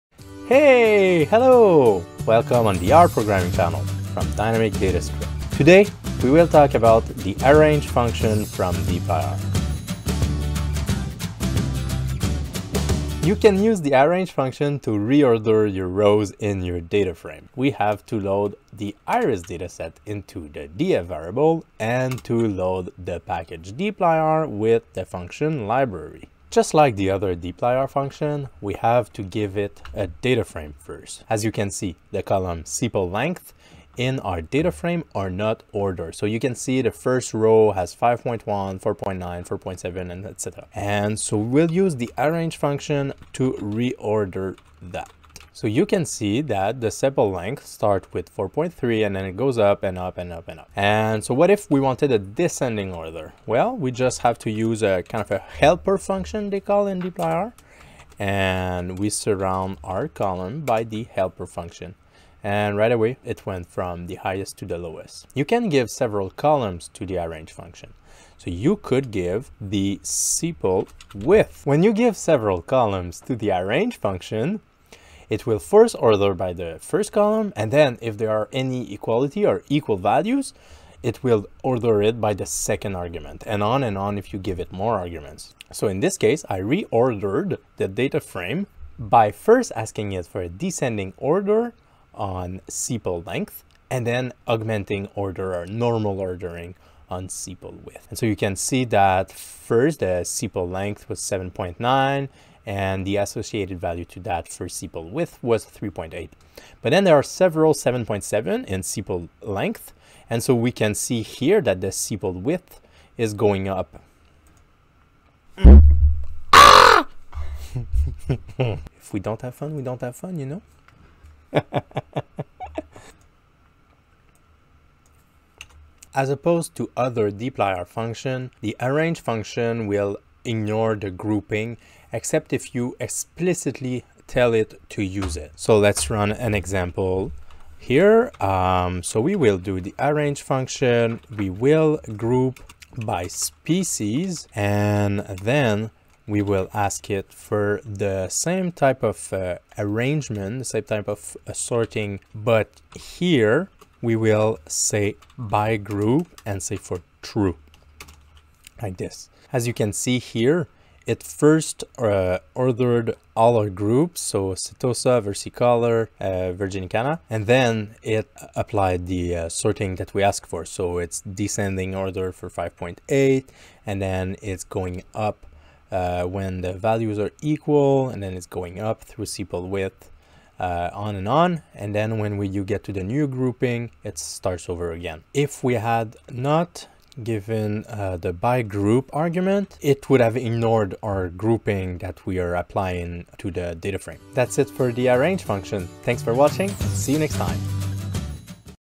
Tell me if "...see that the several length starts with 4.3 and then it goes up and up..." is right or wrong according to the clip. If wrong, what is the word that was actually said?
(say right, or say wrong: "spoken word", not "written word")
wrong: "sepal", not "several".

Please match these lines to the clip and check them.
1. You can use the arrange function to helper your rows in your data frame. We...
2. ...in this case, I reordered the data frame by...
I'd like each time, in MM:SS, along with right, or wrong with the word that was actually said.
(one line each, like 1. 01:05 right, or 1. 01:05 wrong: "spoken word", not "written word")
1. 00:13 wrong: "reorder", not "helper"
2. 01:25 right.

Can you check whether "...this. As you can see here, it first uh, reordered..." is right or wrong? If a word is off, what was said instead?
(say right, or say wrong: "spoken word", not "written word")
wrong: "ordered", not "reordered".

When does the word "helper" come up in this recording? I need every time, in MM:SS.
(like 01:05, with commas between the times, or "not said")
00:55, 01:01.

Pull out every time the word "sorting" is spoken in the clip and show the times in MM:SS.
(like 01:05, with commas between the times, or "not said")
02:31, 02:49.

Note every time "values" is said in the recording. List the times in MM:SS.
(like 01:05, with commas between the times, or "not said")
01:19, 01:43, 02:56.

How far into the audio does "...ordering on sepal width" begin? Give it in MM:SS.
01:36.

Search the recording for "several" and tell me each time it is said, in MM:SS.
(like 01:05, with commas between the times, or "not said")
01:05, 01:12, 01:47.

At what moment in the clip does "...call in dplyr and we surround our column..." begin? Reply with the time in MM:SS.
00:56.